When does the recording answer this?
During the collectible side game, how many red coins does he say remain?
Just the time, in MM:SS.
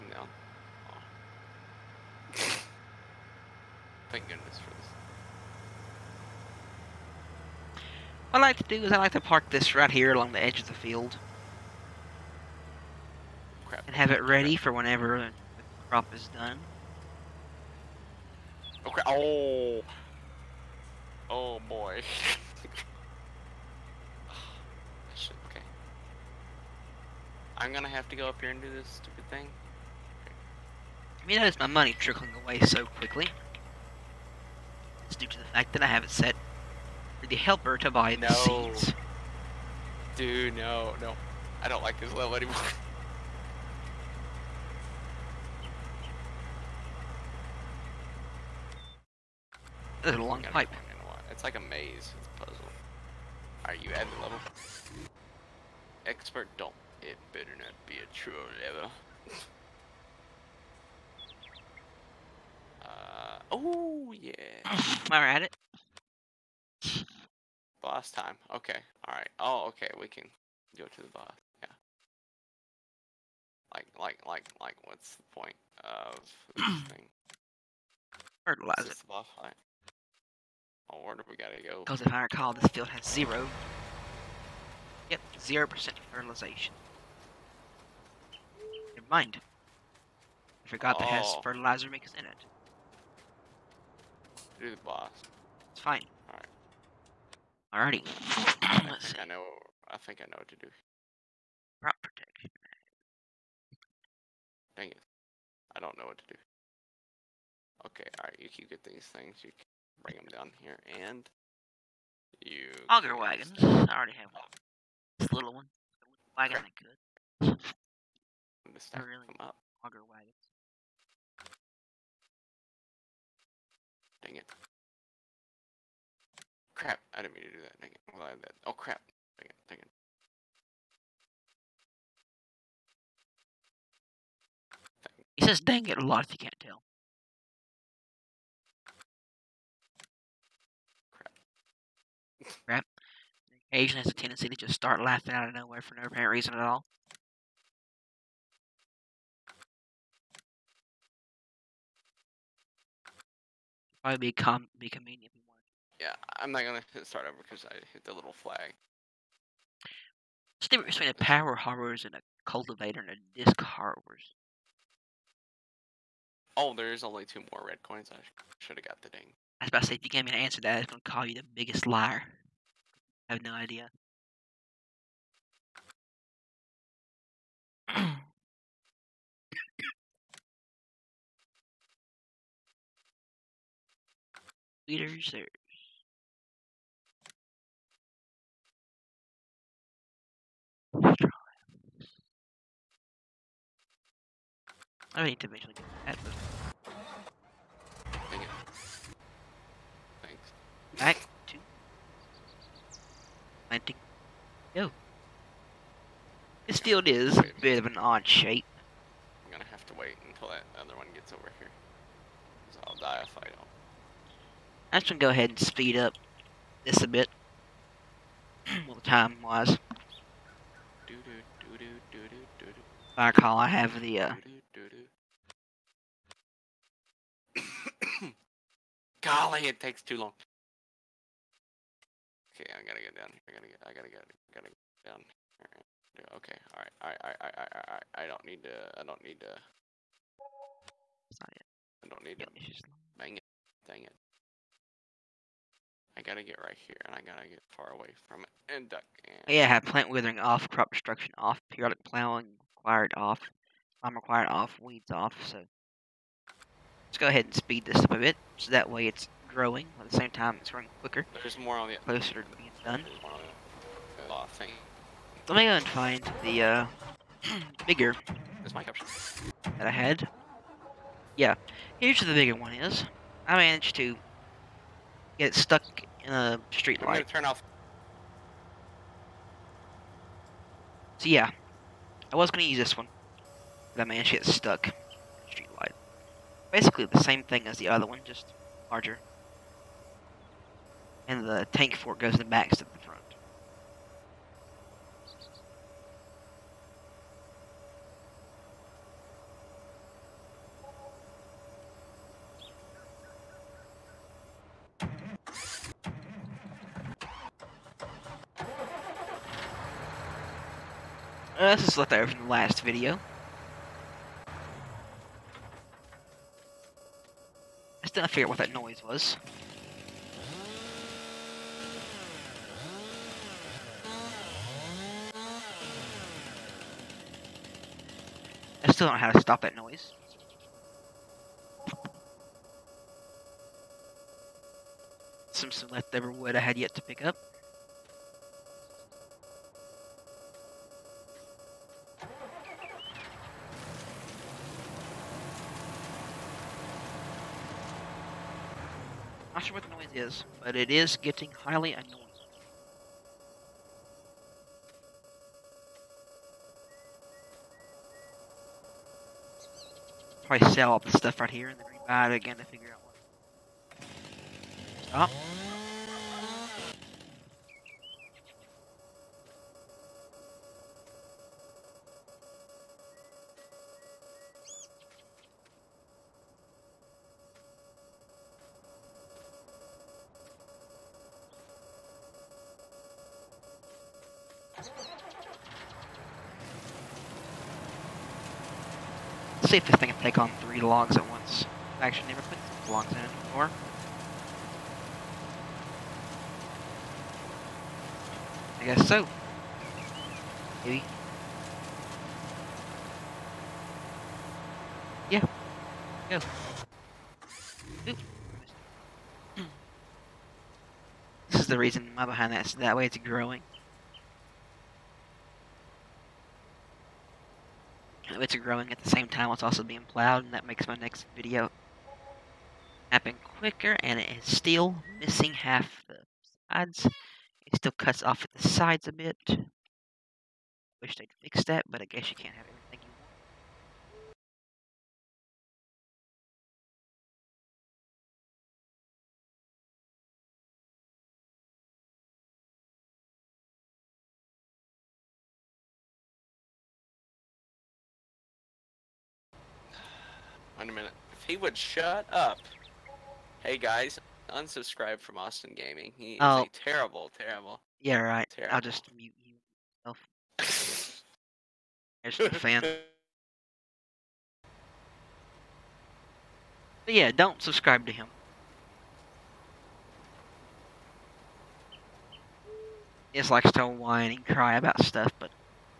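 02:47.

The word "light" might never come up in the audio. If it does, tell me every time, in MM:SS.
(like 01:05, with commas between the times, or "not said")
04:37, 04:45.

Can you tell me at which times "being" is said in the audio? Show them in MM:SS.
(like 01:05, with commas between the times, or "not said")
04:22, 06:59.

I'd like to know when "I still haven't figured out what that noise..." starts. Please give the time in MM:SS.
05:18.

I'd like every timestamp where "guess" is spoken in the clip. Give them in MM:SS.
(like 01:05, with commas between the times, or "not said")
06:38, 07:12.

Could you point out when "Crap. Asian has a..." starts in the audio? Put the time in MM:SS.
02:22.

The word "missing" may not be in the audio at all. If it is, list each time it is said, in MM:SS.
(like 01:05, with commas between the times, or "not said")
07:05.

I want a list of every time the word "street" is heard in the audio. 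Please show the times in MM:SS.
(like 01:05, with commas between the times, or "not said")
04:36, 04:45.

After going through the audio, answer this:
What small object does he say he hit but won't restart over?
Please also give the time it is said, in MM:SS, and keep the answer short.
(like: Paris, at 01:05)
The little flag, at 02:38.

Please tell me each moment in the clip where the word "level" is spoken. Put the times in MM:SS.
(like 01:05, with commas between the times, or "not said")
00:42, 00:54, 00:58.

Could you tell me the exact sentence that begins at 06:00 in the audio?
Probably sell all the stuff right here and then green it again to figure out what.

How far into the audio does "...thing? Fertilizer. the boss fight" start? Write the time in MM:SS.
01:16.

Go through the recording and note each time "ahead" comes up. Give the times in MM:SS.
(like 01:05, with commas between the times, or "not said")
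03:35, 04:17.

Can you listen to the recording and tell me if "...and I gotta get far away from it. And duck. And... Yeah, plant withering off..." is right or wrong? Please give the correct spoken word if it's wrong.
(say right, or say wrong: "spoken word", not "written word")
right.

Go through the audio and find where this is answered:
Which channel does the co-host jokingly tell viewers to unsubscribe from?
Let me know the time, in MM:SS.
07:35.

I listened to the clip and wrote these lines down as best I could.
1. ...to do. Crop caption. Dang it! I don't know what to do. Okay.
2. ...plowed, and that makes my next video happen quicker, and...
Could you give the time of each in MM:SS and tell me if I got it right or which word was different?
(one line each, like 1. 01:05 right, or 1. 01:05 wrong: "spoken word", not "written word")
1. 01:40 wrong: "protection", not "caption"
2. 07:00 right.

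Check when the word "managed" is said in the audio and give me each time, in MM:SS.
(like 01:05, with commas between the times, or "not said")
04:33, 04:44.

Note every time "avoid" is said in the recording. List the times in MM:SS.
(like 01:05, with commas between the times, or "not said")
not said.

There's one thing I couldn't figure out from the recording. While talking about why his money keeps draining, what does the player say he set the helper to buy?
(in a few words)
Seeds.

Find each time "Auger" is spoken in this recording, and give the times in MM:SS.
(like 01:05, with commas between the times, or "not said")
01:52, 01:59.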